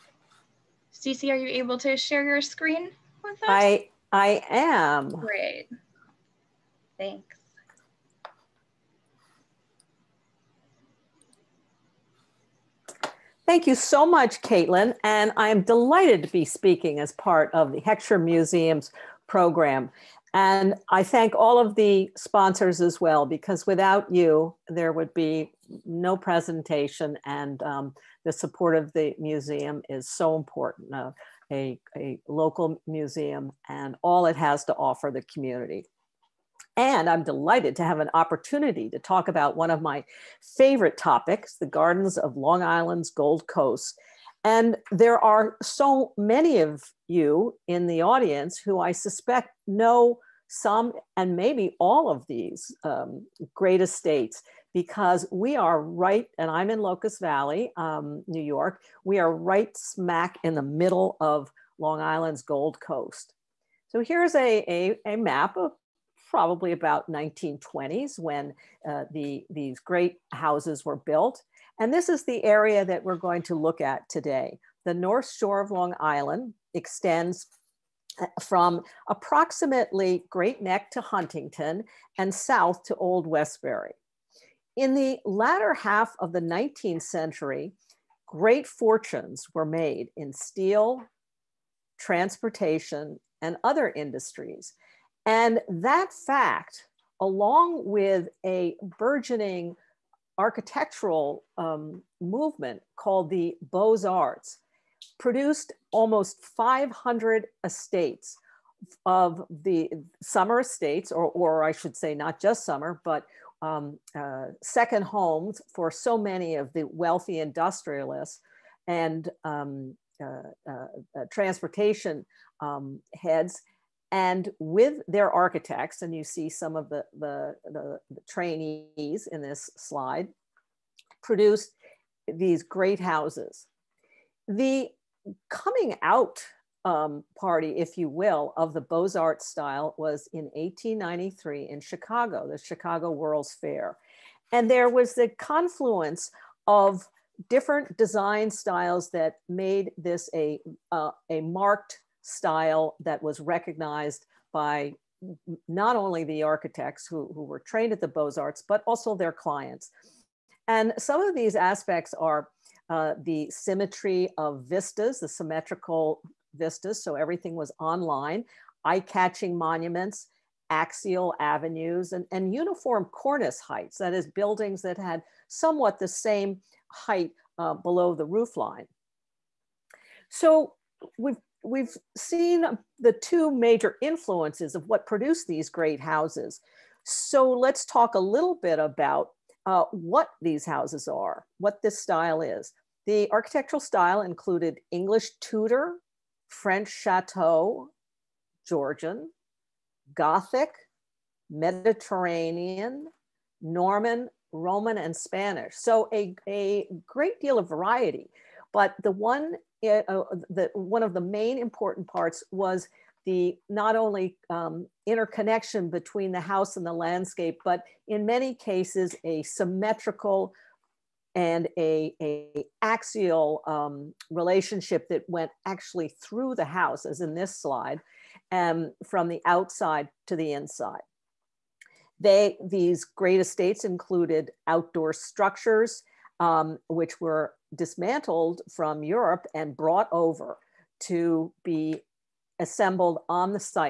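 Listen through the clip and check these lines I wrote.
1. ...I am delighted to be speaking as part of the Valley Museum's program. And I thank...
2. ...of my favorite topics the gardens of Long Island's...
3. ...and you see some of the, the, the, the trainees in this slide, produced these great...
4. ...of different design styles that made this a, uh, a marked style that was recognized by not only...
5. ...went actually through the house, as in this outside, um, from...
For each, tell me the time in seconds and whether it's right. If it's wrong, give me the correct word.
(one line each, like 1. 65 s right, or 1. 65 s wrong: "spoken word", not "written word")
1. 15 s wrong: "Heckscher", not "Valley"
2. 39 s right
3. 126 s right
4. 146 s right
5. 225 s wrong: "slide", not "outside".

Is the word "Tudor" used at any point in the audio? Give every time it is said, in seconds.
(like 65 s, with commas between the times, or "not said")
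195 s.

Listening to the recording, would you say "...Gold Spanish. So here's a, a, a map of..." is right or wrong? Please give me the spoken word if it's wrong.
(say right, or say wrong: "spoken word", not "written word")
wrong: "Coast", not "Spanish".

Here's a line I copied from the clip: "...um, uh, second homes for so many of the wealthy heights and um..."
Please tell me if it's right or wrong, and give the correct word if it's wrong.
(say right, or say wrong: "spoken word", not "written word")
wrong: "industrialists", not "heights".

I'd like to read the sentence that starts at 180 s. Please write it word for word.
So we've we've seen the two major influences of what produced these great houses.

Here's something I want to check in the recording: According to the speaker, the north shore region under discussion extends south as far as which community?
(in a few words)
Old Westbury.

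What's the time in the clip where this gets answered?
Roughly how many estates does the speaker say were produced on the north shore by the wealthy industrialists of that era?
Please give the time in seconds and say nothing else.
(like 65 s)
106 s.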